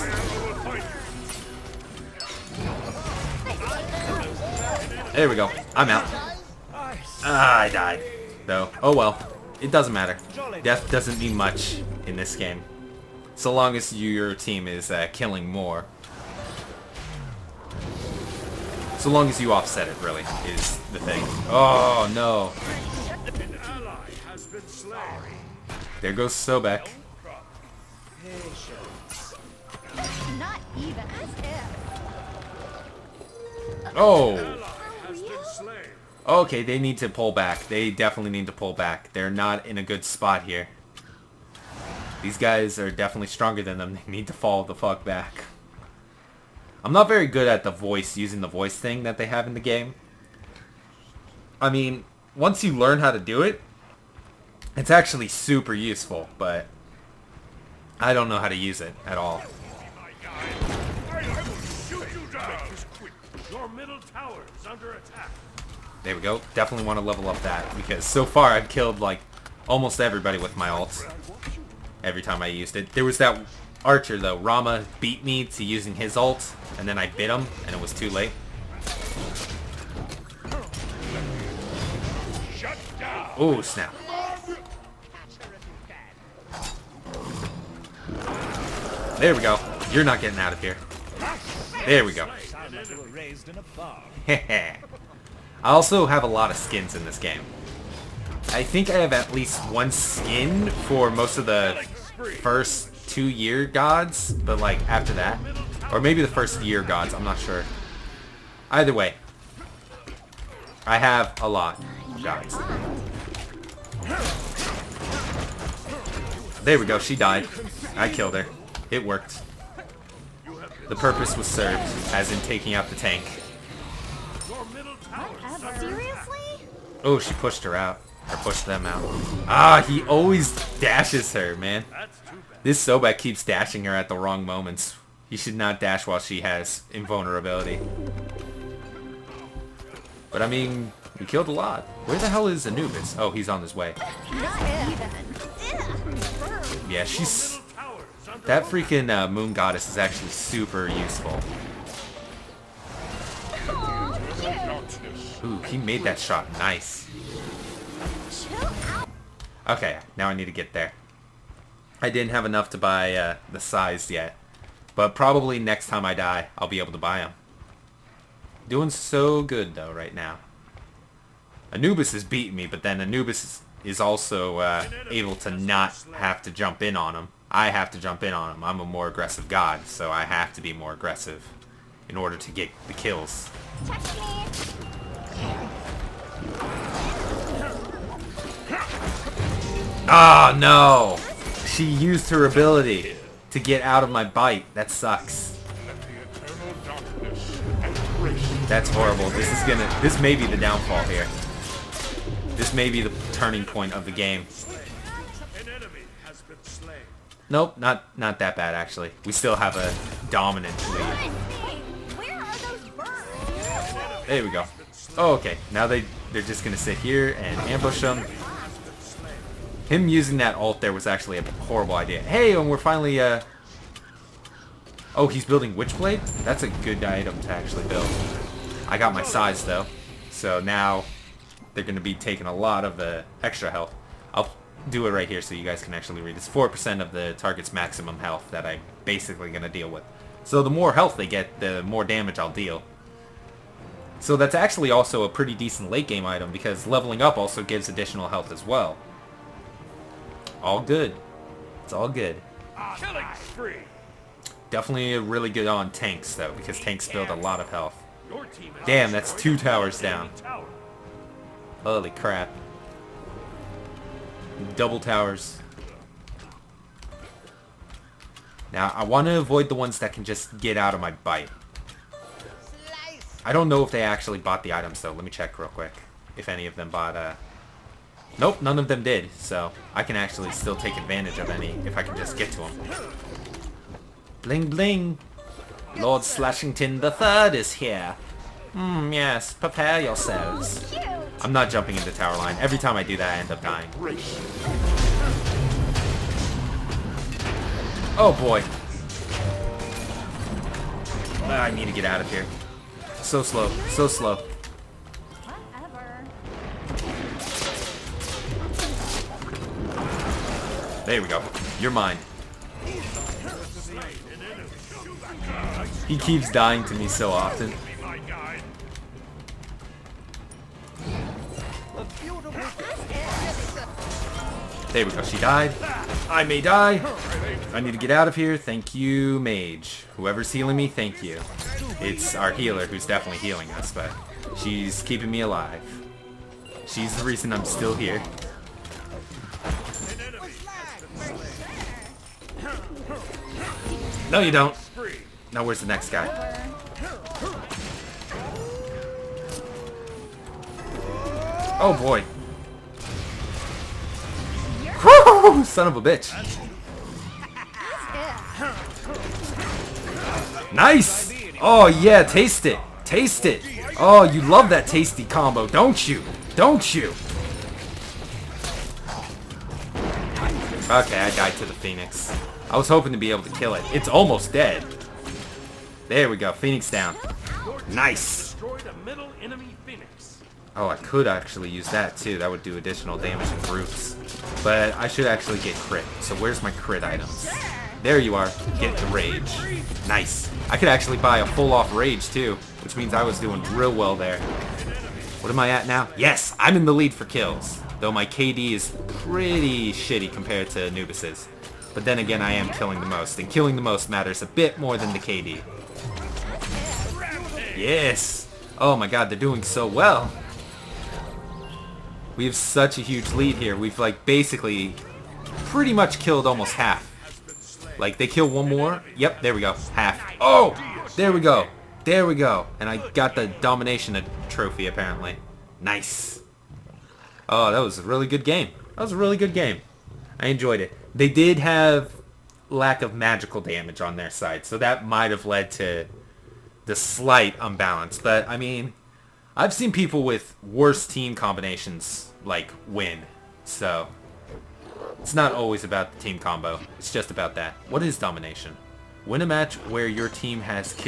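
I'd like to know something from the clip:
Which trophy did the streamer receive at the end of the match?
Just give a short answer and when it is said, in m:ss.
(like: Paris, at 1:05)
domination trophy, at 7:03.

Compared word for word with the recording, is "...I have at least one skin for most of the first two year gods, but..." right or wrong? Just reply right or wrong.
right.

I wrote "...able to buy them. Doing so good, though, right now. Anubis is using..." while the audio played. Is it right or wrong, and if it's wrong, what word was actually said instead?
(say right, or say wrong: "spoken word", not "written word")
wrong: "beating", not "using".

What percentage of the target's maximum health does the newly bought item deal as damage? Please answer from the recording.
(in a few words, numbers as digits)
4%.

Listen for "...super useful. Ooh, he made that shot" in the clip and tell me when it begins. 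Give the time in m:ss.
2:30.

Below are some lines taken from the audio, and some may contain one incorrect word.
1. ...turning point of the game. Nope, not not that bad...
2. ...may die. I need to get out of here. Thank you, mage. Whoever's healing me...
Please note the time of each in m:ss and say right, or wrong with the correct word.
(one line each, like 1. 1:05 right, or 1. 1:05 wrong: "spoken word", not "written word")
1. 3:23 right
2. 5:26 right.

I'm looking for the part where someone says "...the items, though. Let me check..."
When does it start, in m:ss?
4:34.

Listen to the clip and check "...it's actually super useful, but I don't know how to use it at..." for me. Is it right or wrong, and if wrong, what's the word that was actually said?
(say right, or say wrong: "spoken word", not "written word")
right.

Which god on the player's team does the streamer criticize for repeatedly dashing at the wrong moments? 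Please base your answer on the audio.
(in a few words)
Sobek.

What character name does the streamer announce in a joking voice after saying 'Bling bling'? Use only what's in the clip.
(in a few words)
Lord Slashington the Third.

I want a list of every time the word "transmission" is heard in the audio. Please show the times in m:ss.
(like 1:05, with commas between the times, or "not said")
not said.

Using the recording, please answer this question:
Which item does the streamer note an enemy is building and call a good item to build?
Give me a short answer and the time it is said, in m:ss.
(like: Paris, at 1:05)
Witchblade, at 3:45.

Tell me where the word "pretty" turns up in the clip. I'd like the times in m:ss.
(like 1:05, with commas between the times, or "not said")
4:05, 6:39, 6:55.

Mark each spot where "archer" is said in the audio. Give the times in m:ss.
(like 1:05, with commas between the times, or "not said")
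1:13.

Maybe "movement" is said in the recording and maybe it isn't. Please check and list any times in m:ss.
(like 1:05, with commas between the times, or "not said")
not said.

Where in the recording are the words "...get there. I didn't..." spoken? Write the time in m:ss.
2:40.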